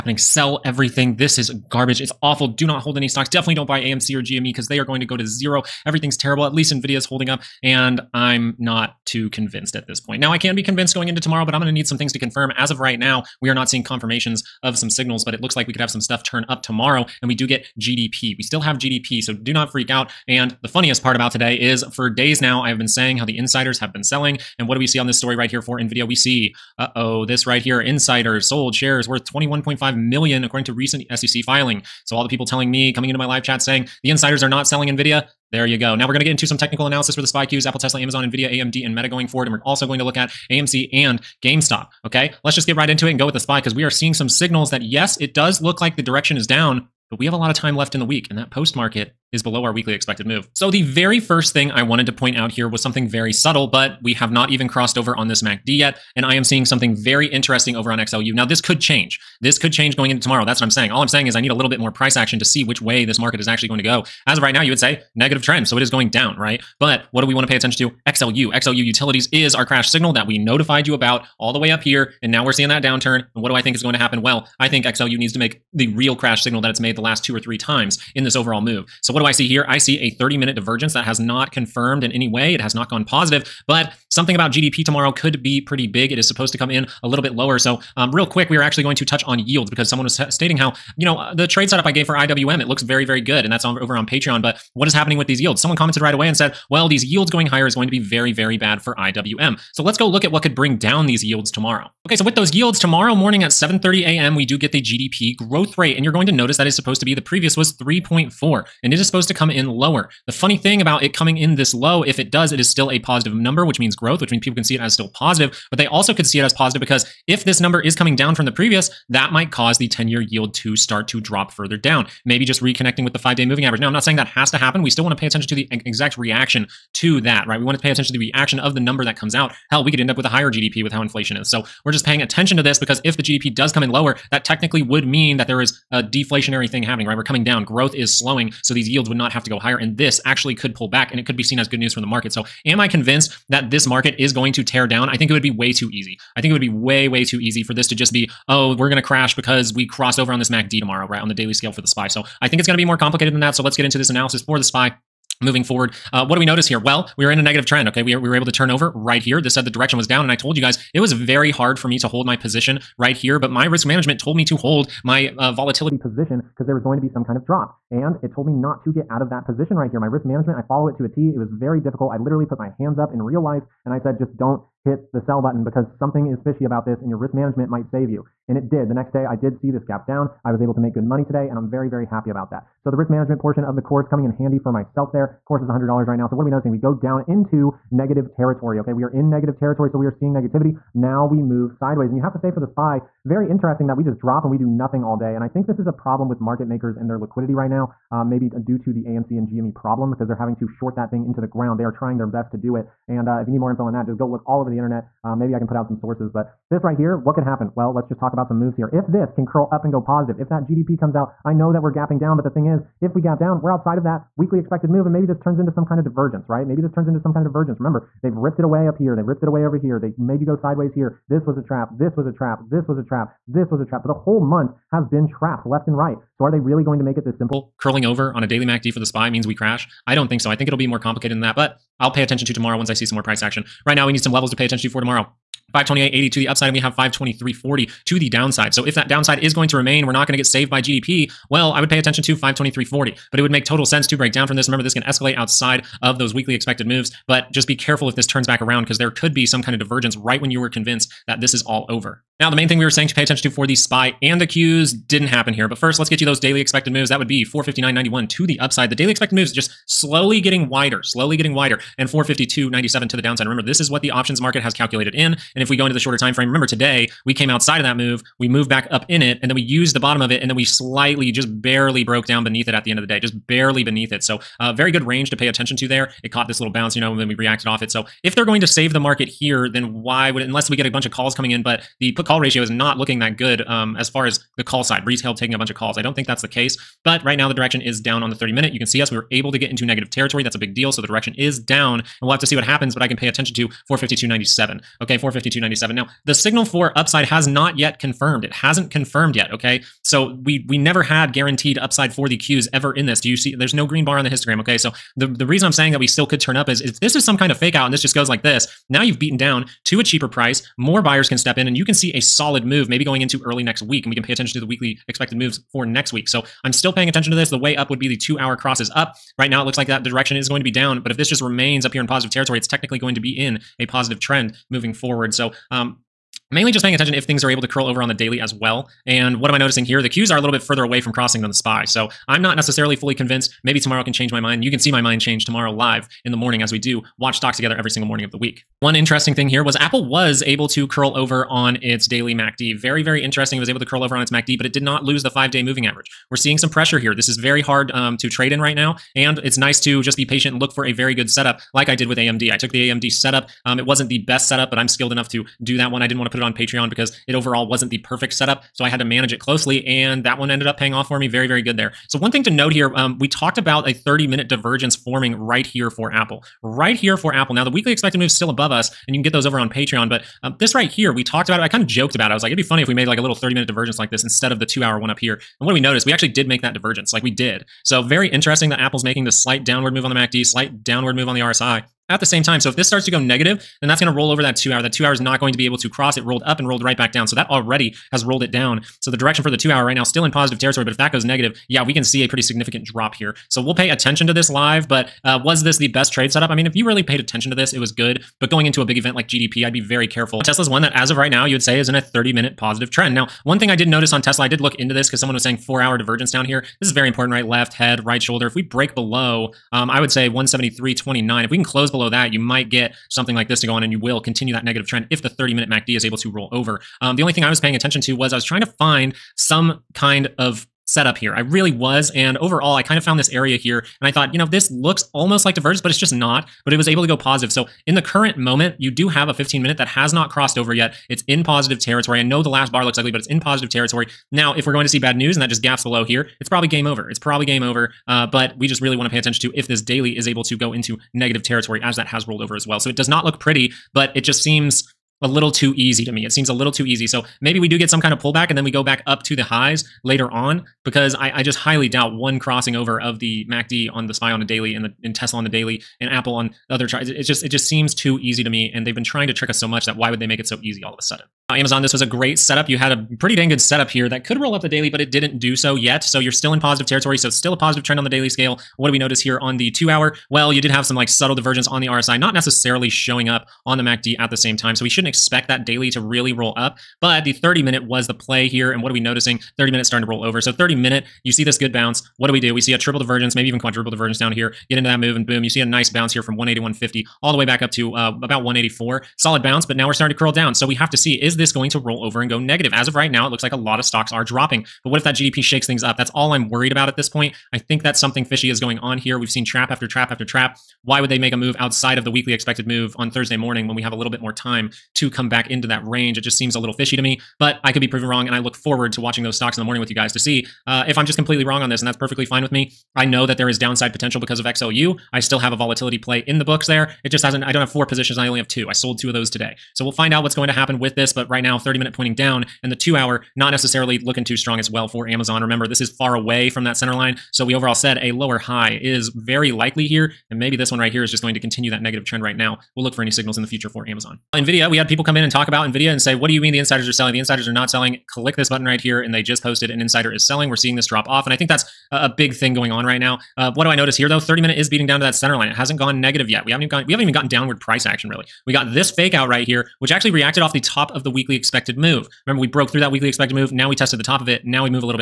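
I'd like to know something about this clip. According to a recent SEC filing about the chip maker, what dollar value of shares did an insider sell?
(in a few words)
$21.5 million.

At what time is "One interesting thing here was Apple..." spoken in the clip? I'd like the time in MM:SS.
05:38.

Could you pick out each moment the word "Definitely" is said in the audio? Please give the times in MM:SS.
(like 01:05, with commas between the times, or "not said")
00:03.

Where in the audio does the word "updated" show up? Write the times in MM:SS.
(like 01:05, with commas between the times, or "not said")
not said.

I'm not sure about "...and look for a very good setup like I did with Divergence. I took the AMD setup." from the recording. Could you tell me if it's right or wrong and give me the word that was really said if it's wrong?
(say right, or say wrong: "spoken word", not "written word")
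wrong: "AMD", not "Divergence".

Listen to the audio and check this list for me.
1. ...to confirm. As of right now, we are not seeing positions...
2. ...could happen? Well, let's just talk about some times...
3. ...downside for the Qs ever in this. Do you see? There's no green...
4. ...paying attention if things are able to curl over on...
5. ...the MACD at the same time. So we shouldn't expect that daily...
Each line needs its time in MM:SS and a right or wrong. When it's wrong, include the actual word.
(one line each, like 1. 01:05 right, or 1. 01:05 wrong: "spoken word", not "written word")
1. 00:12 wrong: "confirmations", not "positions"
2. 03:27 wrong: "moves", not "times"
3. 05:01 wrong: "upside", not "downside"
4. 05:26 right
5. 07:53 right.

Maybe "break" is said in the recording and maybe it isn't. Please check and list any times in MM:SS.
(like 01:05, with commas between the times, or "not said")
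04:04, 06:48.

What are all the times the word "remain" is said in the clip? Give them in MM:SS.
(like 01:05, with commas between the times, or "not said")
03:59, 05:21.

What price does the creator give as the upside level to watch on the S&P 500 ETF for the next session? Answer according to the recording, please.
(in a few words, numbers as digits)
528.80.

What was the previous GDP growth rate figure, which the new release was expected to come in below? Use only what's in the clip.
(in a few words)
3.4.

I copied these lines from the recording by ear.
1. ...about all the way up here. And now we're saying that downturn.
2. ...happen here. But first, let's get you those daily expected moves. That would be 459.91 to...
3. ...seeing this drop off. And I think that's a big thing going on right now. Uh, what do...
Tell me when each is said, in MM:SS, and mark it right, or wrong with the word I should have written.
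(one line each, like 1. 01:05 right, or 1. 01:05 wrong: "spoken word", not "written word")
1. 01:10 wrong: "seeing", not "saying"
2. 04:15 right
3. 09:00 right.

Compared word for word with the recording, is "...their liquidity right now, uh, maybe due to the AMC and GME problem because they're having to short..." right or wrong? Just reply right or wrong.
right.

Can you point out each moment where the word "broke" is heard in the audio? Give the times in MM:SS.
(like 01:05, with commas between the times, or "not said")
04:32, 09:12.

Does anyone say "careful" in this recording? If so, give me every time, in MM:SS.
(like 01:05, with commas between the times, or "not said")
04:07, 06:40.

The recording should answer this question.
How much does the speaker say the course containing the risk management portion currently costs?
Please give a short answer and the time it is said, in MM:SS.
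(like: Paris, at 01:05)
$100, at 03:05.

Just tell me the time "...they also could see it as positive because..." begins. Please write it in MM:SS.
01:55.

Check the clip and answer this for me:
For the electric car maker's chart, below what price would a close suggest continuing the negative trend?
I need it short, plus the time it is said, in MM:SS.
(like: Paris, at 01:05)
173.29, at 06:50.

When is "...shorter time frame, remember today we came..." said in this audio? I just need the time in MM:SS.
04:25.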